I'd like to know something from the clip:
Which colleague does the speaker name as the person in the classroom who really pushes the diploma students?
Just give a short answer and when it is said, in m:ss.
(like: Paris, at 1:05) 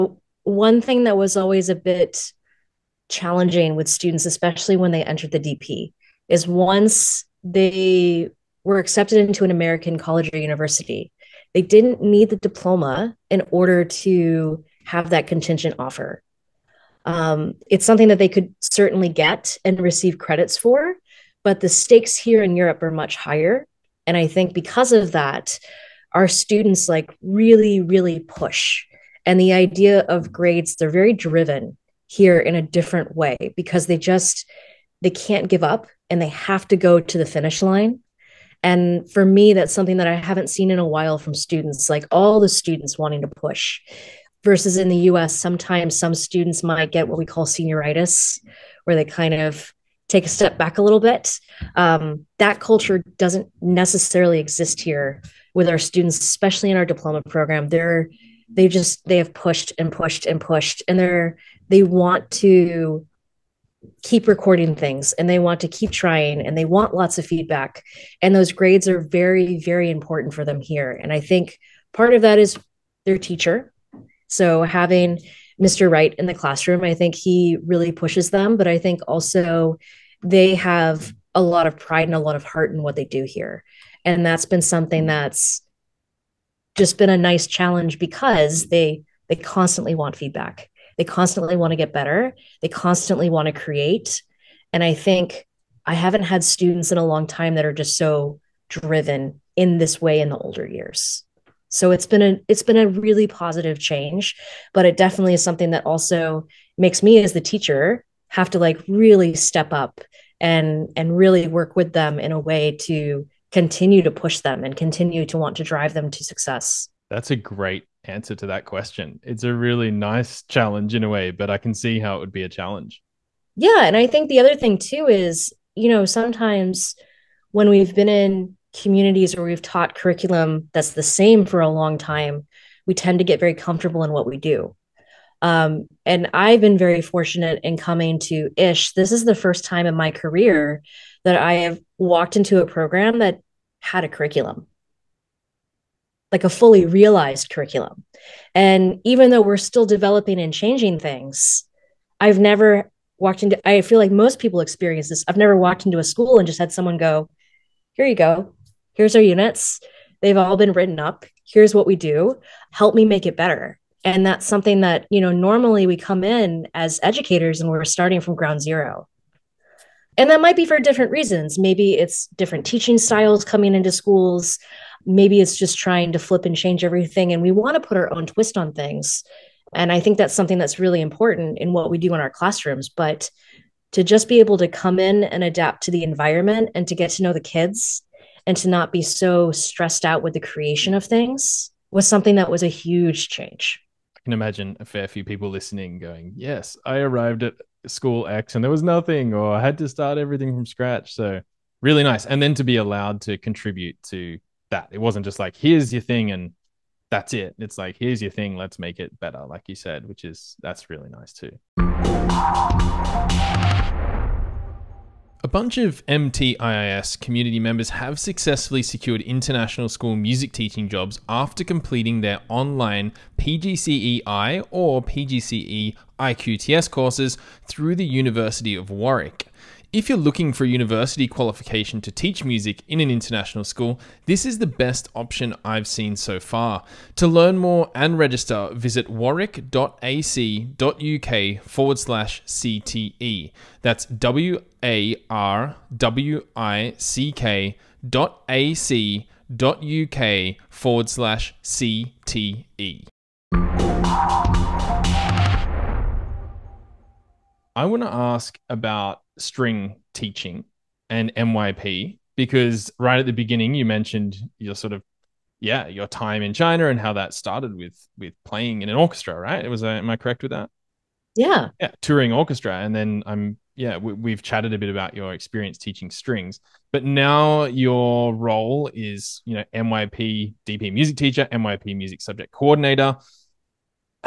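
Mr Wright, at 1:15.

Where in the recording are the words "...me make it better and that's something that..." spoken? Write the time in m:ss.
2:42.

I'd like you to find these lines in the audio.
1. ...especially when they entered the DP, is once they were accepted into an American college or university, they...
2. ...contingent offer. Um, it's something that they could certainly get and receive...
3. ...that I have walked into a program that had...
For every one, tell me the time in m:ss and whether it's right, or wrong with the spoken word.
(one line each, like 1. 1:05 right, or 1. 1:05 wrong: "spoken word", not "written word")
1. 0:04 right
2. 0:15 right
3. 2:21 right.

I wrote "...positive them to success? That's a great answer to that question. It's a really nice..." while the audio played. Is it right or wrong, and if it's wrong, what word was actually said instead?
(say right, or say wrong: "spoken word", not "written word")
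wrong: "drive", not "positive".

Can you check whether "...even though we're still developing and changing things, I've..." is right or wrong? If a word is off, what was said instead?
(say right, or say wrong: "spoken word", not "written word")
right.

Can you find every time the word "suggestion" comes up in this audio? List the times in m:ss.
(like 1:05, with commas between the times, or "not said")
not said.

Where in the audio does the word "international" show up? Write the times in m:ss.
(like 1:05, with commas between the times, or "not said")
3:39, 3:53.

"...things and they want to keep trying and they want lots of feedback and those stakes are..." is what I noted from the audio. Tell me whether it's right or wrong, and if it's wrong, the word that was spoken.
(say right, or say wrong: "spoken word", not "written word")
wrong: "grades", not "stakes".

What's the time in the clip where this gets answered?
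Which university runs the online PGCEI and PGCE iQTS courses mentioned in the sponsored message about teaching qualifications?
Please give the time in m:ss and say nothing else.
3:48.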